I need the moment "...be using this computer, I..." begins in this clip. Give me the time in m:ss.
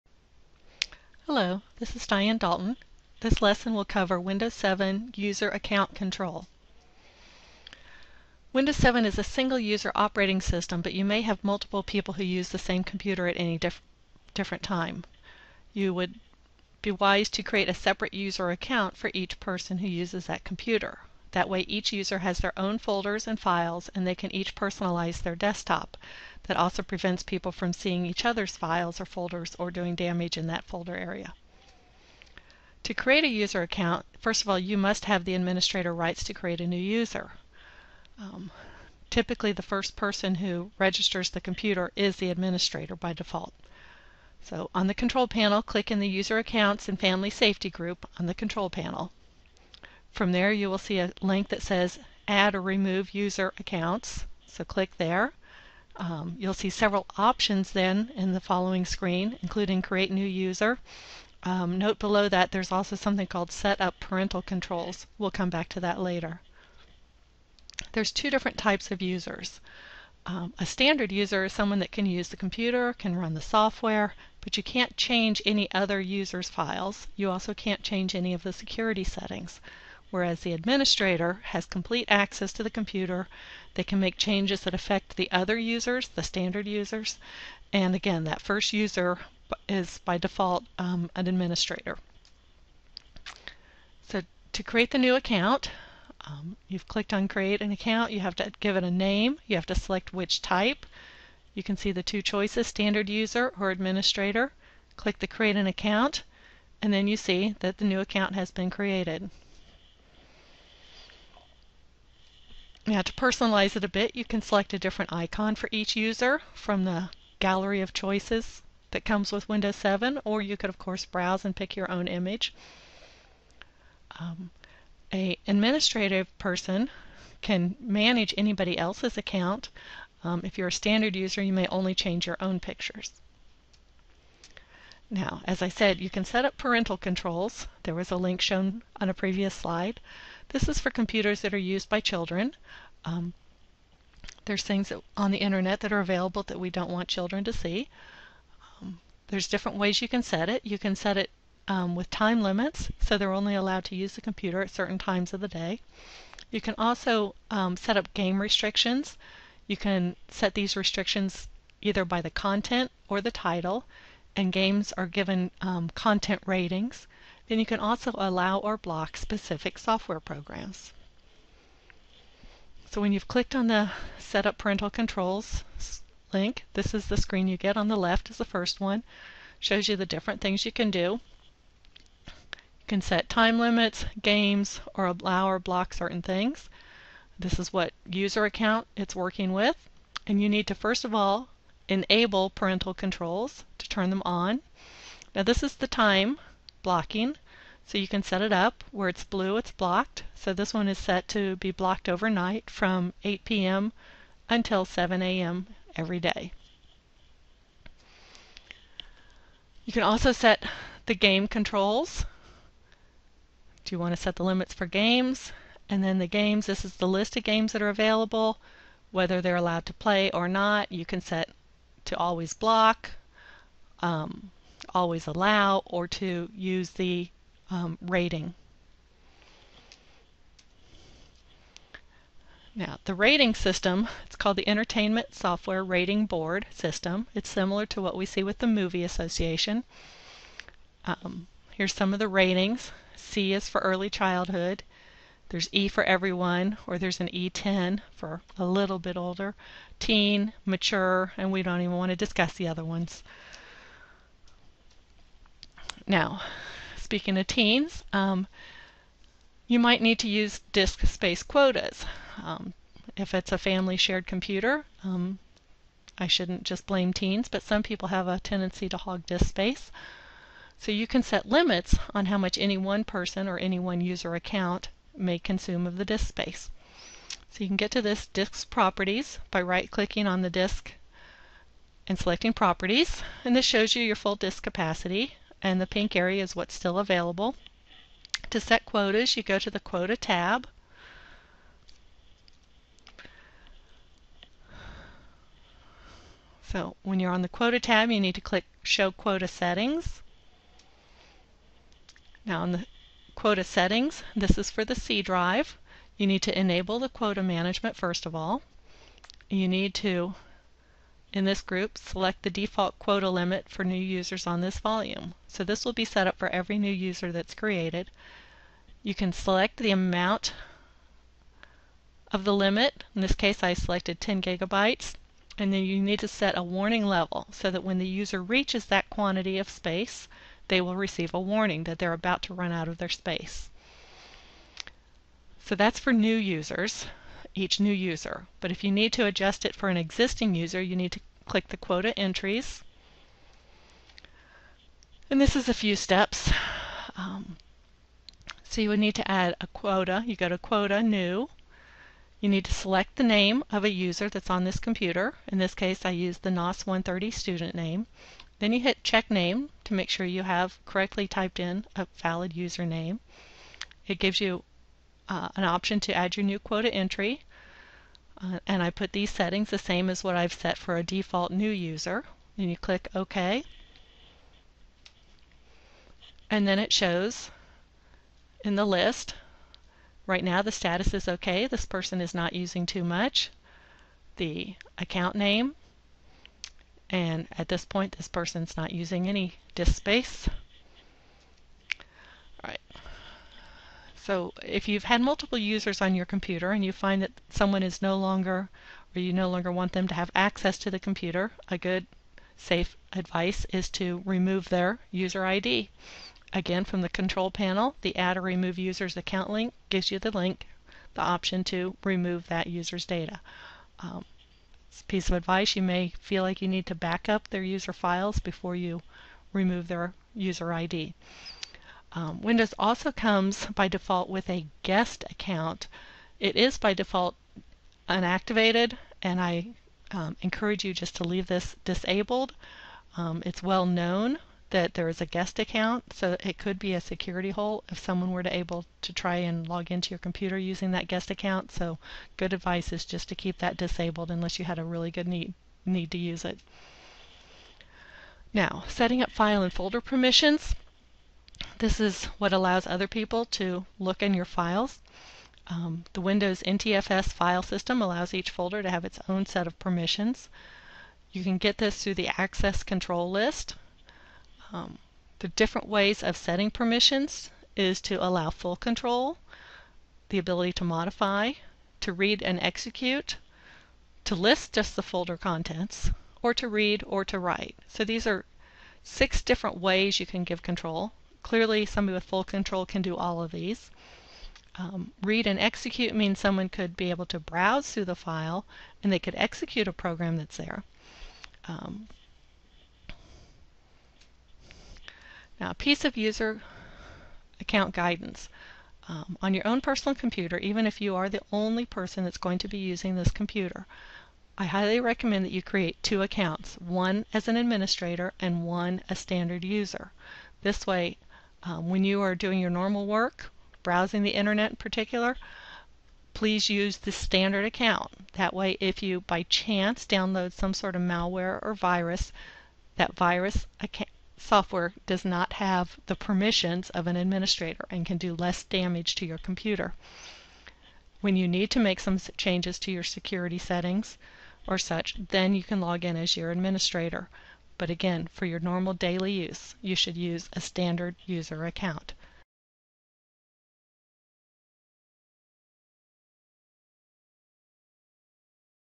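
8:22.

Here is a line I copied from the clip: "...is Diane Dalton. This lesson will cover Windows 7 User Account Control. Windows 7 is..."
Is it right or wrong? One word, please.
right.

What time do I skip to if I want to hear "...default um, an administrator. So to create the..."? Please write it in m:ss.
1:30.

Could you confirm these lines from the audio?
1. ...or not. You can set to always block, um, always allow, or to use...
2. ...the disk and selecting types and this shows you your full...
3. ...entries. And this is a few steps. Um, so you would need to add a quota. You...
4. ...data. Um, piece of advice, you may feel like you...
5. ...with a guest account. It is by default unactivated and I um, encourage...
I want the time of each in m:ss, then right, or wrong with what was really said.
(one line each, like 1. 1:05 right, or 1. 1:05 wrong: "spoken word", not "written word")
1. 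3:40 right
2. 4:40 wrong: "properties", not "types"
3. 5:42 right
4. 6:53 right
5. 7:04 right.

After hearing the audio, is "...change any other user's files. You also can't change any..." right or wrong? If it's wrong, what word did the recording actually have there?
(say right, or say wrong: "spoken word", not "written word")
right.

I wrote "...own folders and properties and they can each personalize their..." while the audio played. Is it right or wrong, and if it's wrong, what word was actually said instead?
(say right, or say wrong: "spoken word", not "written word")
wrong: "files", not "properties".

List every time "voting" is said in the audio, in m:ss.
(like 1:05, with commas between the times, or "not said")
not said.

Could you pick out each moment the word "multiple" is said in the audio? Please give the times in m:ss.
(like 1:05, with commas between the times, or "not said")
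0:11, 6:35.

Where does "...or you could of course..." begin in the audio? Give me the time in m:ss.
2:00.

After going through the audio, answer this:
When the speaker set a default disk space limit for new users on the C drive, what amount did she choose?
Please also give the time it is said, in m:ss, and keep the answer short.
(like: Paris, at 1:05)
10 gigabytes, at 5:24.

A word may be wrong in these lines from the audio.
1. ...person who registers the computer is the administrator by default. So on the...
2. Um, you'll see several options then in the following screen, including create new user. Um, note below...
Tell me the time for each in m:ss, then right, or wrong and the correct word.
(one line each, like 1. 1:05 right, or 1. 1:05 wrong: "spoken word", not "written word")
1. 0:39 right
2. 0:55 right.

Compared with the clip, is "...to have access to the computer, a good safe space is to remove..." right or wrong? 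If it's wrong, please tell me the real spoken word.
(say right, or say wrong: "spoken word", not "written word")
wrong: "advice", not "space".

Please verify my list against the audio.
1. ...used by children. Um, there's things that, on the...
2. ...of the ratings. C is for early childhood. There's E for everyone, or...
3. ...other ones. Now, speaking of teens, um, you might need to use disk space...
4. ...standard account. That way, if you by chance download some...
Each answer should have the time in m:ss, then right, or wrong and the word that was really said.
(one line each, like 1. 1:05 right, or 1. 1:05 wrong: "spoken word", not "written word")
1. 2:21 right
2. 4:02 right
3. 4:12 right
4. 8:37 right.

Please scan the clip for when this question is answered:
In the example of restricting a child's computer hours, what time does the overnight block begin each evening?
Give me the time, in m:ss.
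3:23.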